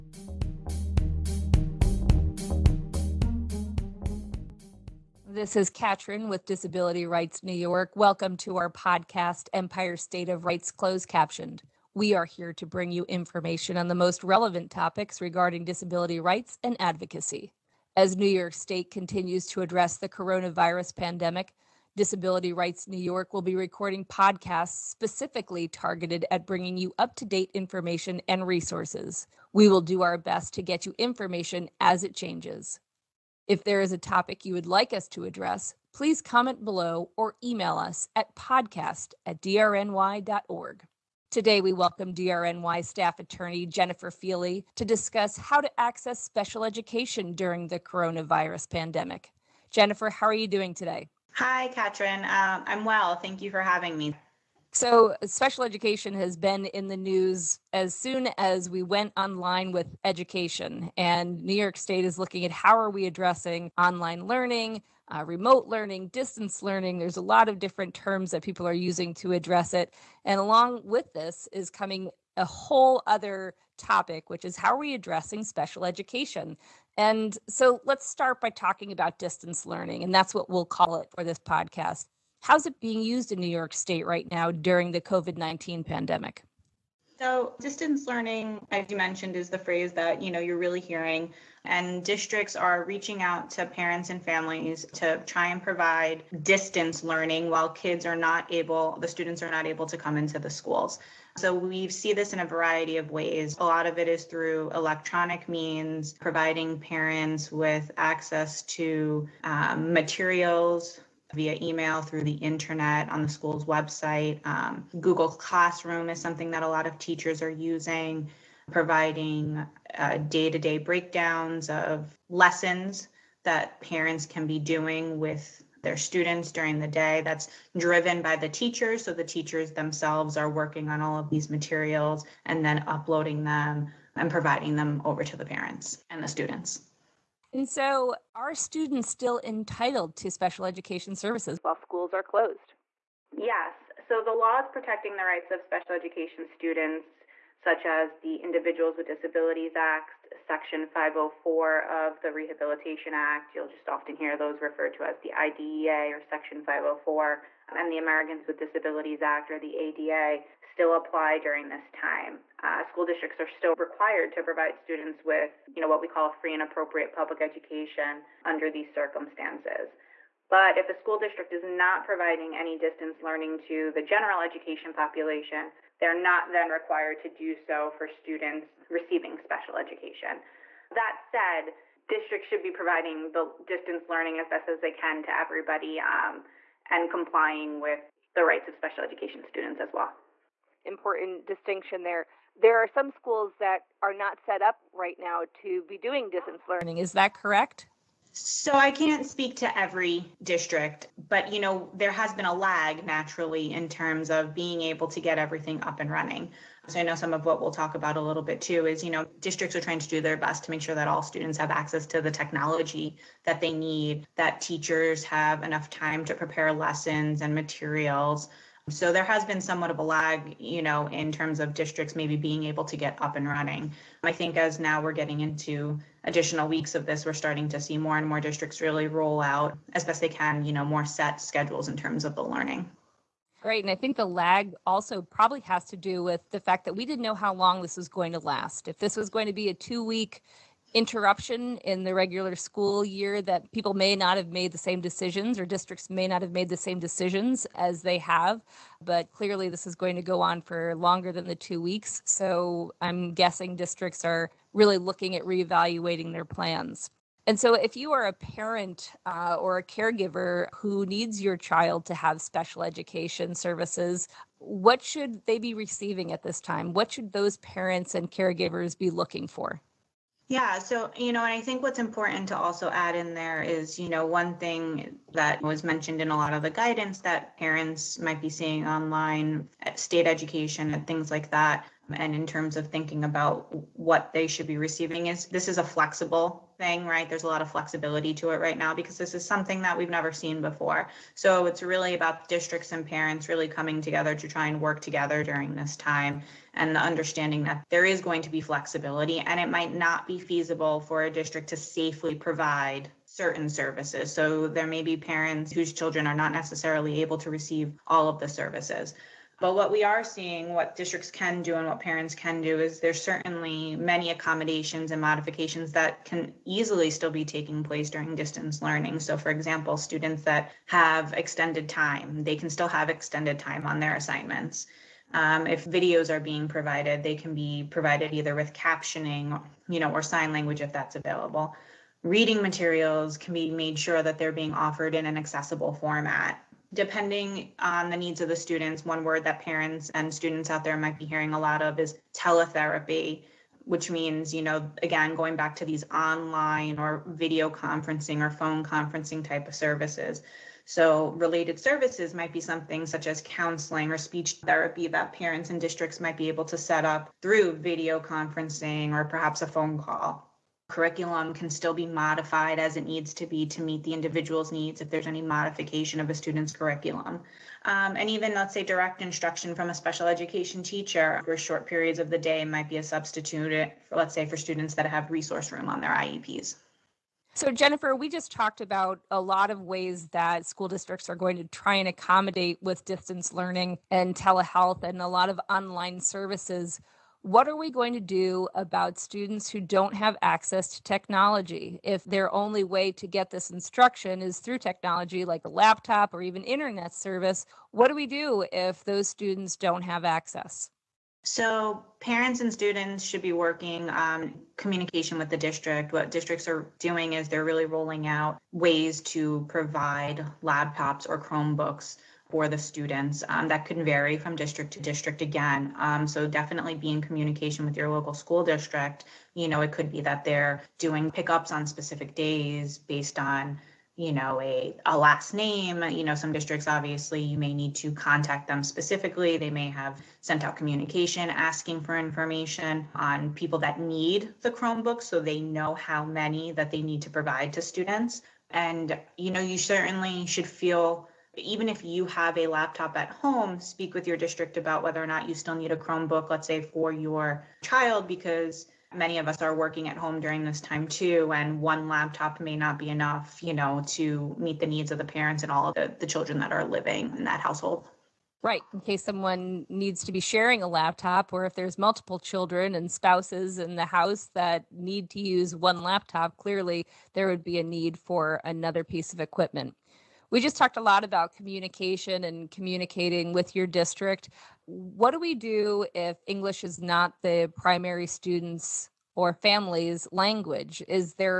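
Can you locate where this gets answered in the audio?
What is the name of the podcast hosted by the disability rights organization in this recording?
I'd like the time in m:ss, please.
0:09.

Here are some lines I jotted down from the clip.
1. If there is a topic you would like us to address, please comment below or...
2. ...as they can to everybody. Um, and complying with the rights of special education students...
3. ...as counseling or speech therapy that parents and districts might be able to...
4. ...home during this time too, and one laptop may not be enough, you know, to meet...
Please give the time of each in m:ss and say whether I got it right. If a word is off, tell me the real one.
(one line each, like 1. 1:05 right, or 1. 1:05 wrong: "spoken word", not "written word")
1. 0:33 right
2. 3:04 right
3. 5:53 right
4. 7:30 right.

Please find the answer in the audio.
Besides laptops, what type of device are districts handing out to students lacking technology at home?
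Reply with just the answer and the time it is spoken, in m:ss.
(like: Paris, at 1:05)
Chromebooks, at 6:51.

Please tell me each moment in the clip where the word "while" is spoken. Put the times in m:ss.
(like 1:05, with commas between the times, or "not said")
1:37, 2:21.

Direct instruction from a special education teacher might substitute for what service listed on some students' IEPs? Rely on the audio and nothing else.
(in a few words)
resource room.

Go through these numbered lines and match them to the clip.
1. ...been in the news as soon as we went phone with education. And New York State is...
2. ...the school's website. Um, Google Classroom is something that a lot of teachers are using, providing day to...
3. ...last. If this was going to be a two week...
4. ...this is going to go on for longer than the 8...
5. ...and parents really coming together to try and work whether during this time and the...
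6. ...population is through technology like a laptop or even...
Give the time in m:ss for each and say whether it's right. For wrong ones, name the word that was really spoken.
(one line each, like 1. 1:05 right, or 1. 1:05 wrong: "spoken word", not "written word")
1. 0:56 wrong: "online", not "phone"
2. 1:53 right
3. 3:58 right
4. 4:09 wrong: "2", not "8"
5. 4:52 wrong: "together", not "whether"
6. 6:33 wrong: "instruction", not "population".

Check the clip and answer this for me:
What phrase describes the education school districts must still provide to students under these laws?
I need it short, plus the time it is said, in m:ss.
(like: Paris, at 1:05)
free and appropriate public education, at 2:46.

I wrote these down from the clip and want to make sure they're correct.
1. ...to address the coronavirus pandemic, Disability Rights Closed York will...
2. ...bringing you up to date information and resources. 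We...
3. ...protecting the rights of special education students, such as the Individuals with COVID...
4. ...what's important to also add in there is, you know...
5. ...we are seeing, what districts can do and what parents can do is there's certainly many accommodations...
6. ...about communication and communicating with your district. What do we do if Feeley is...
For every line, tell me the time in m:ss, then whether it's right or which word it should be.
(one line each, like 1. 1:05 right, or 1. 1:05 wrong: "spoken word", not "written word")
1. 0:19 wrong: "New", not "Closed"
2. 0:26 right
3. 2:24 wrong: "Disabilities", not "COVID"
4. 4:31 right
5. 5:09 right
6. 7:51 wrong: "English", not "Feeley".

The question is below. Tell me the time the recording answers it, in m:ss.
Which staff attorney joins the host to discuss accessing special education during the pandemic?
0:43.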